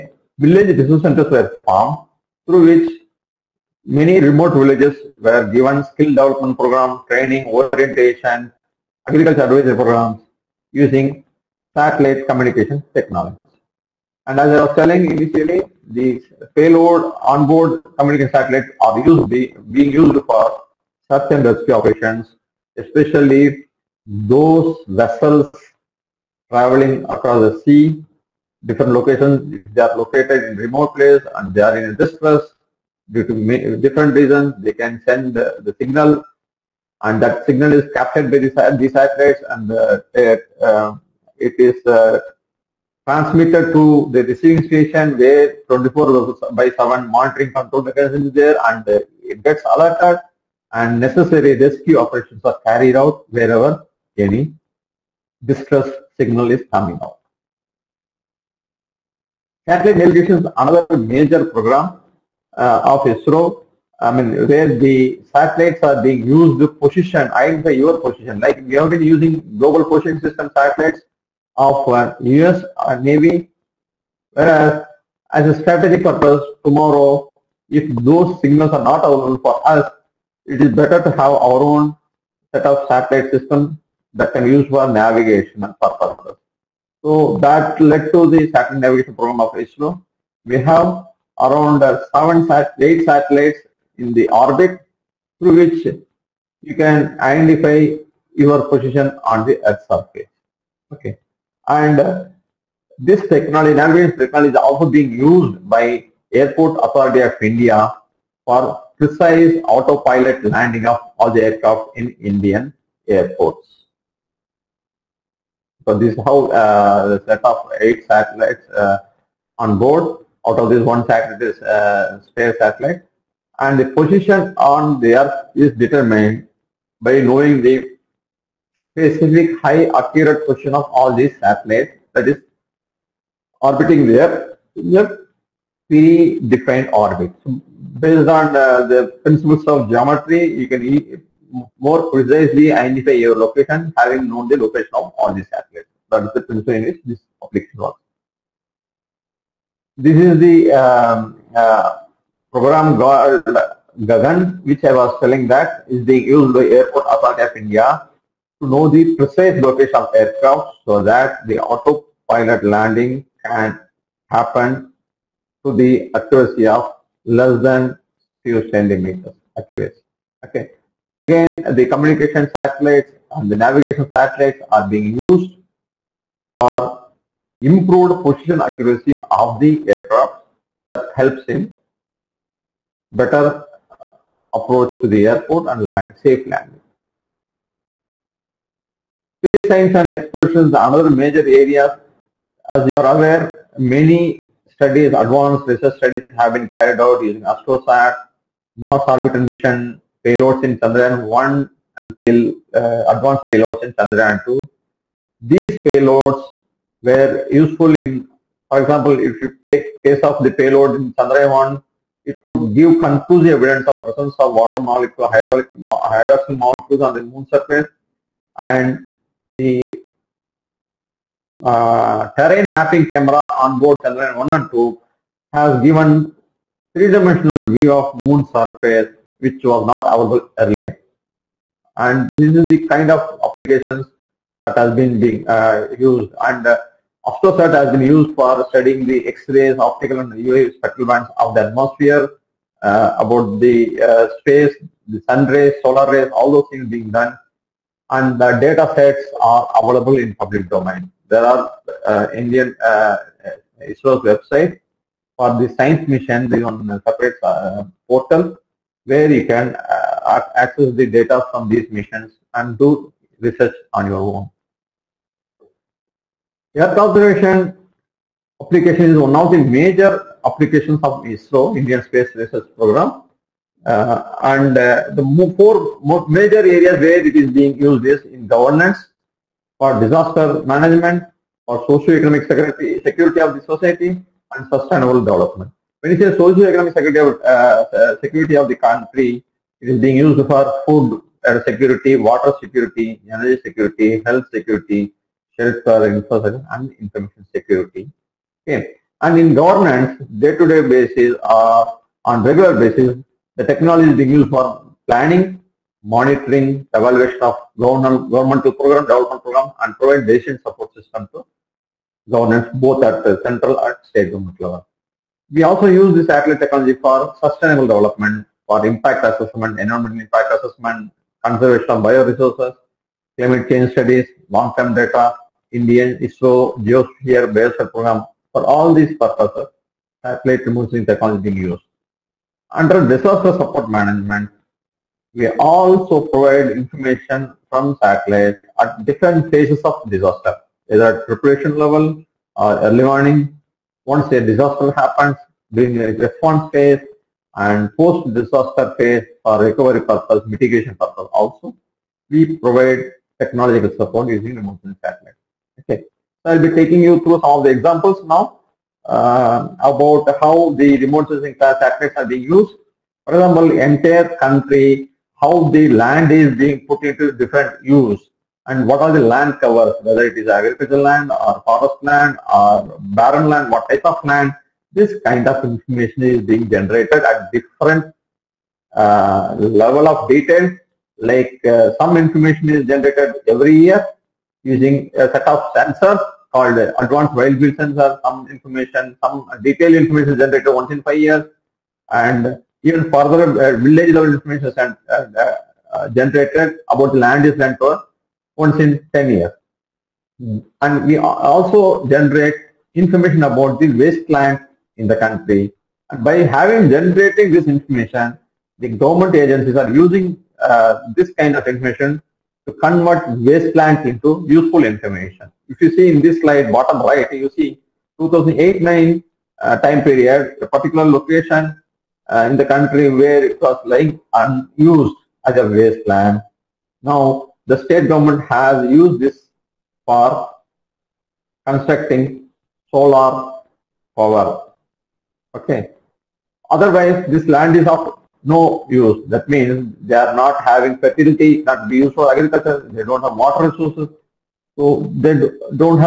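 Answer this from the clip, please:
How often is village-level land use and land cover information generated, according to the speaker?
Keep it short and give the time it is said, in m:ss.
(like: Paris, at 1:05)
once in 10 years, at 6:38.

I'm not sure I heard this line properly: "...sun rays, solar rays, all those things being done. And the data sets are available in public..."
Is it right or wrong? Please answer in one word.
right.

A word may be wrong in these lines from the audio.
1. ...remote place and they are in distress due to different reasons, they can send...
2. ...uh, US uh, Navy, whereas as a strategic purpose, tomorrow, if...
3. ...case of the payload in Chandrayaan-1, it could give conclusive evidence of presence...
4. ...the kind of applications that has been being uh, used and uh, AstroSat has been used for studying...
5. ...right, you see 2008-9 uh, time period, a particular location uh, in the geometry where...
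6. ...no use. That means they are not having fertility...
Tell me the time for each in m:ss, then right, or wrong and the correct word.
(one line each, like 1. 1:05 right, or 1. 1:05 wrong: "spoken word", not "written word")
1. 0:30 right
2. 1:11 right
3. 3:30 right
4. 3:52 right
5. 6:57 wrong: "country", not "geometry"
6. 7:18 right.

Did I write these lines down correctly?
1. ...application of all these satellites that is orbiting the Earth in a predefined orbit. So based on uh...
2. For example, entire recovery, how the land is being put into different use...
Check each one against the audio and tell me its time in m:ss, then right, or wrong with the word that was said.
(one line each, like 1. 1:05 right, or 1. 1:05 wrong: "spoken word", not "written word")
1. 2:10 wrong: "position", not "application"
2. 6:03 wrong: "country", not "recovery".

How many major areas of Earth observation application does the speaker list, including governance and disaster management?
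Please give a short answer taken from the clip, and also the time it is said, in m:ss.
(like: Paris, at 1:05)
4, at 4:35.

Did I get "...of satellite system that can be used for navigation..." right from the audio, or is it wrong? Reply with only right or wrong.
right.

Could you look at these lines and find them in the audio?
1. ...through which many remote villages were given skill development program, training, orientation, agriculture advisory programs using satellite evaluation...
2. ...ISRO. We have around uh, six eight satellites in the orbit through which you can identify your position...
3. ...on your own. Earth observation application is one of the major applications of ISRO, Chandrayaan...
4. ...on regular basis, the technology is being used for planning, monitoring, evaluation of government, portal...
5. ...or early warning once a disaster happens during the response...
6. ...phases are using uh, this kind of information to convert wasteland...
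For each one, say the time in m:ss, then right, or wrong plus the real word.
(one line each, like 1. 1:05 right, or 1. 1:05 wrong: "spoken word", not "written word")
1. 0:02 wrong: "communication", not "evaluation"
2. 1:29 wrong: "seven", not "six"
3. 4:23 wrong: "Indian", not "Chandrayaan"
4. 5:02 wrong: "governmental", not "portal"
5. 5:42 right
6. 6:49 wrong: "agencies", not "phases".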